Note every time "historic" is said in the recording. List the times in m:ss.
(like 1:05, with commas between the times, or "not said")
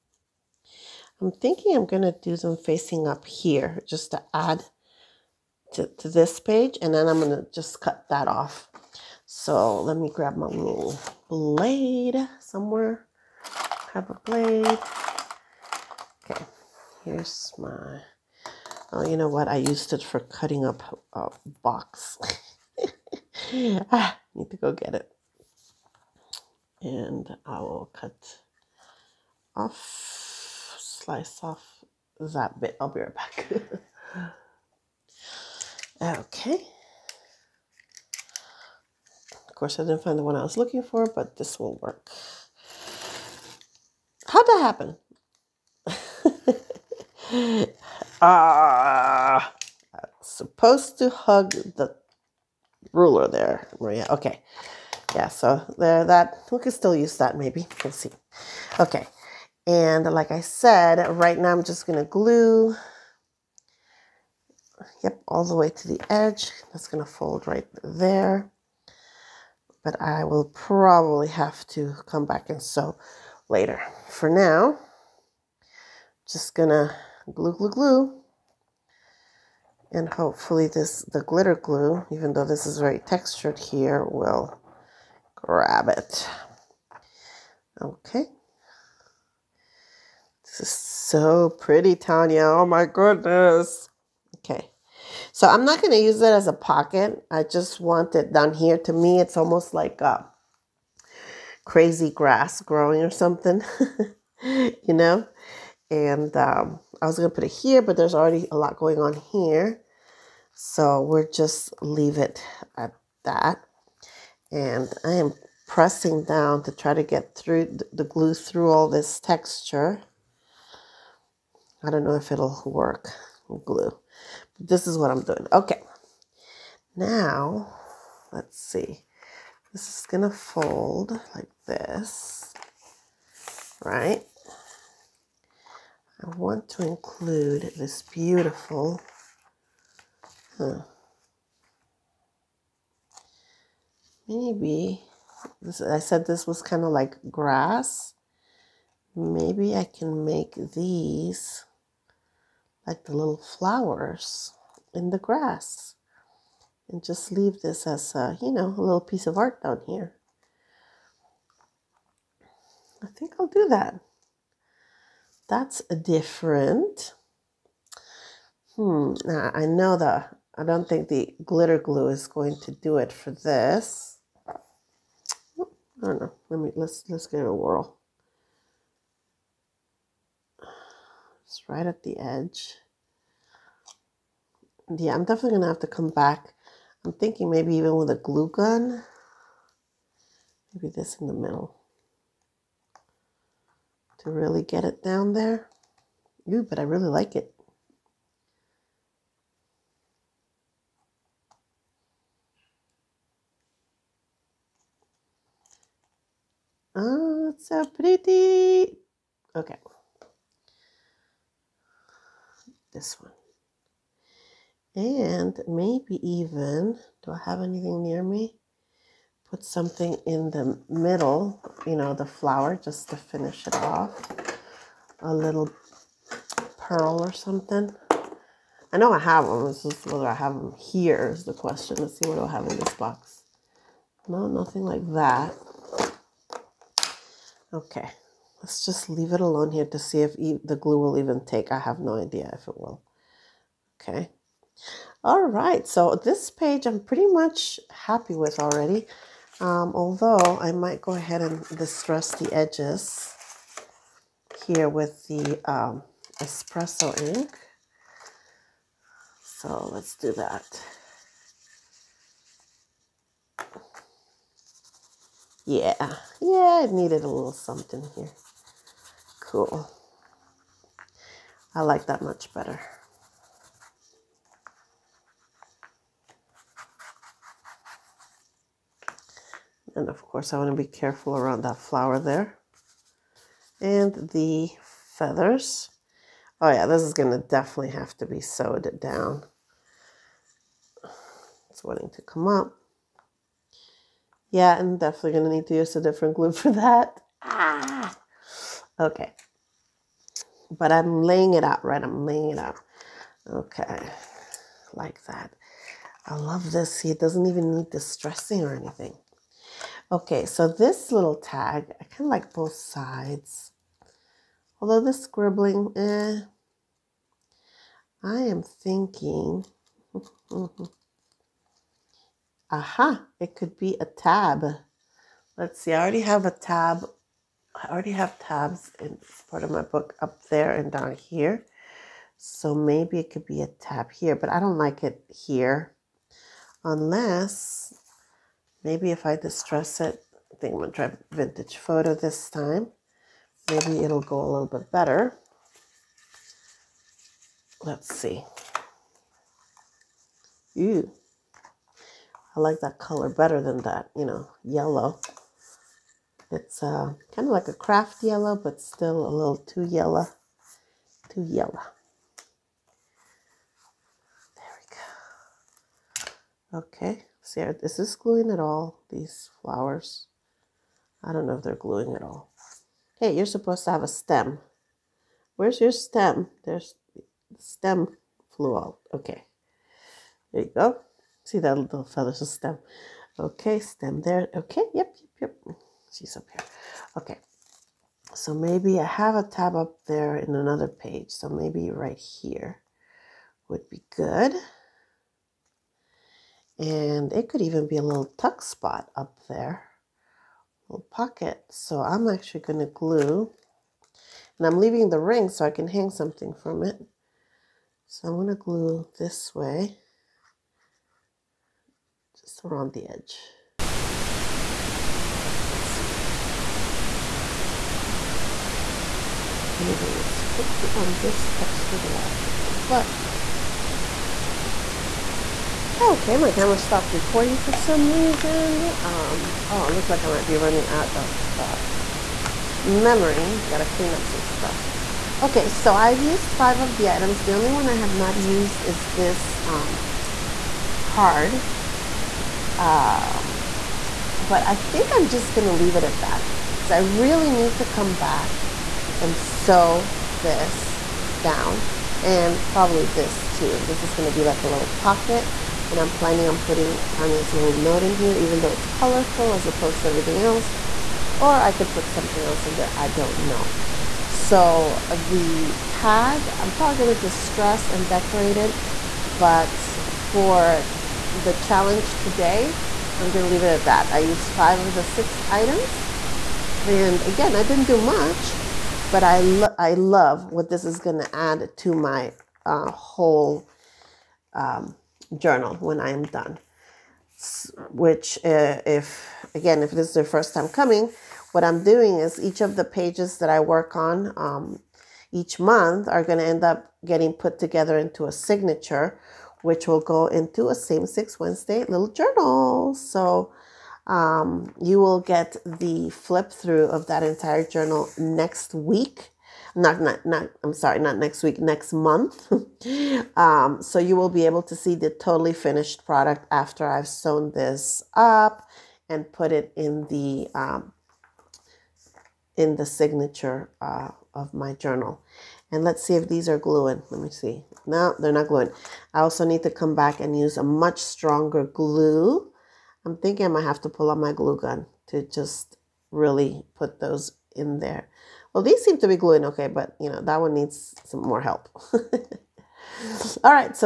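not said.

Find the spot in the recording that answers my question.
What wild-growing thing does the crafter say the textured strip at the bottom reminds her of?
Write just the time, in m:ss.
1:41.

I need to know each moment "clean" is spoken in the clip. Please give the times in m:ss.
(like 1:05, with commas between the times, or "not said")
7:13.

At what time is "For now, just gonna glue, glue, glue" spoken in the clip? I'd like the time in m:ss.
1:14.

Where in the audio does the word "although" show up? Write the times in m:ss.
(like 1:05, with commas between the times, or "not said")
4:09, 5:14.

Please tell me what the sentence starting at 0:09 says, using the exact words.
So let me grab my little blade somewhere.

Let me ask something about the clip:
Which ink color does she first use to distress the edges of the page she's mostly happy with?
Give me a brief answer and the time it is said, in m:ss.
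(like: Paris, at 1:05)
espresso, at 4:16.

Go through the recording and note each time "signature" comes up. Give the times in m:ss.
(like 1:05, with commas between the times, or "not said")
8:18, 8:42.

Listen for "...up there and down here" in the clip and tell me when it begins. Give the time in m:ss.
5:30.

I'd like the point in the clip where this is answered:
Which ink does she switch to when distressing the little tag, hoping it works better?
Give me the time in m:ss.
5:41.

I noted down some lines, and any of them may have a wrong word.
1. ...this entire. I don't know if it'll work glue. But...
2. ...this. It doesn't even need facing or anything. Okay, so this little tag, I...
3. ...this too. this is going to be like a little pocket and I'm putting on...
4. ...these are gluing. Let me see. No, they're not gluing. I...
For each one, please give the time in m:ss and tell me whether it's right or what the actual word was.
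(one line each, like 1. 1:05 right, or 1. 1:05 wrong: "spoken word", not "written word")
1. 1:58 wrong: "texture", not "entire"
2. 5:06 wrong: "distressing", not "facing"
3. 7:33 wrong: "planning", not "putting"
4. 8:46 right.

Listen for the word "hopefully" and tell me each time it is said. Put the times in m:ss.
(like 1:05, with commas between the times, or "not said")
1:20.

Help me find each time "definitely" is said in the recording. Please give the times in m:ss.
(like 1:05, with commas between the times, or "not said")
3:05, 4:47, 4:54.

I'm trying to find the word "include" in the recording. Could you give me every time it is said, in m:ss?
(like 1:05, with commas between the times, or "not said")
2:16.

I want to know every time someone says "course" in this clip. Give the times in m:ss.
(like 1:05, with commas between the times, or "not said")
0:39, 4:40.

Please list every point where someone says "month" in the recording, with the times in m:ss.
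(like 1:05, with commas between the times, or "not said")
8:15, 8:31.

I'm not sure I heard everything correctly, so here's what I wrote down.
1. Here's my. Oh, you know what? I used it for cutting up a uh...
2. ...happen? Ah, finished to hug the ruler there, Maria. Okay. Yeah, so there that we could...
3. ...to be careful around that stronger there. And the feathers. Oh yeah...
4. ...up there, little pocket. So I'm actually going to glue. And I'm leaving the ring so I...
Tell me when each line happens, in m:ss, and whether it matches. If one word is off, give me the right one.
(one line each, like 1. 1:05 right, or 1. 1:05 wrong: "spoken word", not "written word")
1. 0:17 right
2. 0:44 wrong: "supposed", not "finished"
3. 4:40 wrong: "flower", not "stronger"
4. 6:39 right.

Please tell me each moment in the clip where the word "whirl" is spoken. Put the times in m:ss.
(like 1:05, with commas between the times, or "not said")
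2:57.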